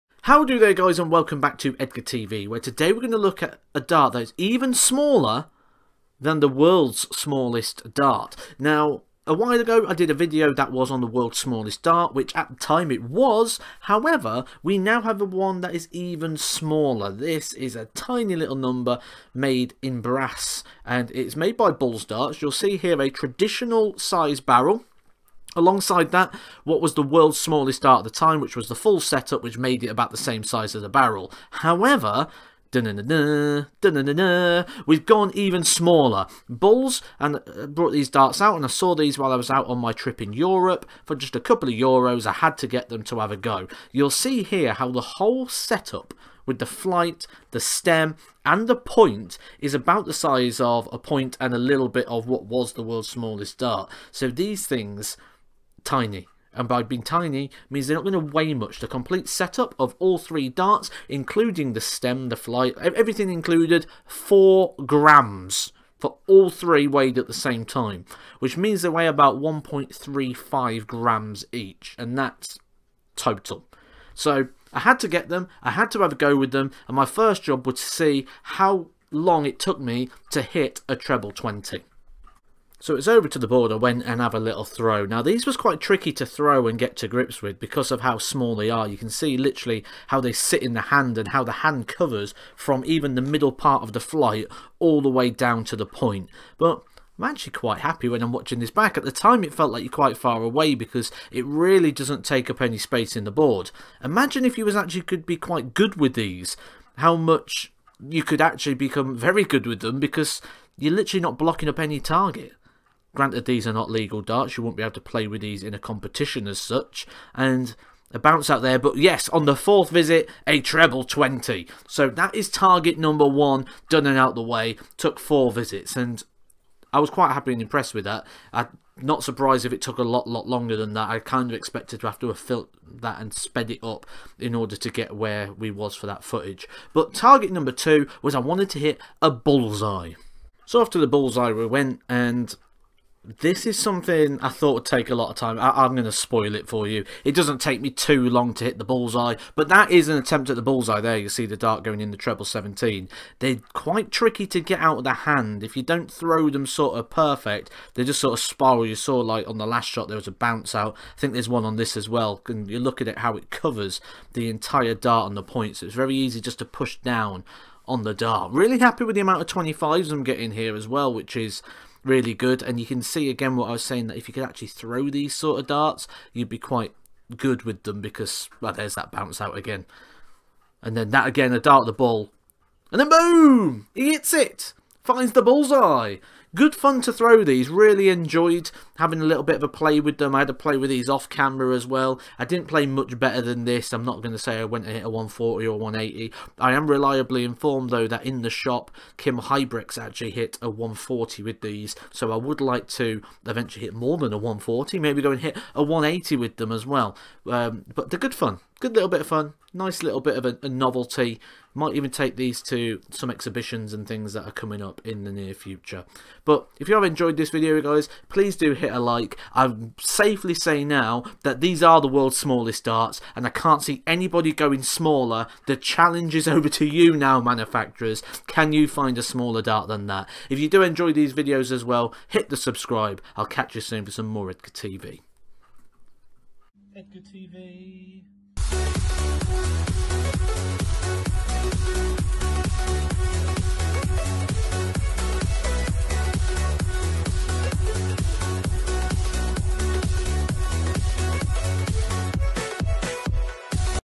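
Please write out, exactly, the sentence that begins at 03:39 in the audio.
I safely say now that these are the world's smallest darts, and I can't see anybody going smaller.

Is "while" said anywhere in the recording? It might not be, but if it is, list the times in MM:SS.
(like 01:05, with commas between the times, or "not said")
00:09, 00:39.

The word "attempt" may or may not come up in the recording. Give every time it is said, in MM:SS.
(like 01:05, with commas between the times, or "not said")
02:30.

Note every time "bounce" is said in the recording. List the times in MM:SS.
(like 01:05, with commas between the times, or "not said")
01:58, 02:40, 02:59.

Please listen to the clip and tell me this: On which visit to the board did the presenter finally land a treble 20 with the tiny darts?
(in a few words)
Fourth.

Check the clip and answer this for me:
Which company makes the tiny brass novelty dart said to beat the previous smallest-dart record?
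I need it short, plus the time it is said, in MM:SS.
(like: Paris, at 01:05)
Bulls Darts, at 00:21.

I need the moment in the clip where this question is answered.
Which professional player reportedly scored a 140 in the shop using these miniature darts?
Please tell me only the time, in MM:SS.
03:19.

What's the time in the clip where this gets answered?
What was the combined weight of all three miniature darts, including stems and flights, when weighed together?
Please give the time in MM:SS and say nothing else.
01:04.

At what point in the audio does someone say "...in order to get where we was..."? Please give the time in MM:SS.
02:14.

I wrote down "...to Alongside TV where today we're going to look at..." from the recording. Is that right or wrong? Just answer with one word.
wrong.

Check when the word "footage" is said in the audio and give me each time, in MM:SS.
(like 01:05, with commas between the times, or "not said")
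02:16.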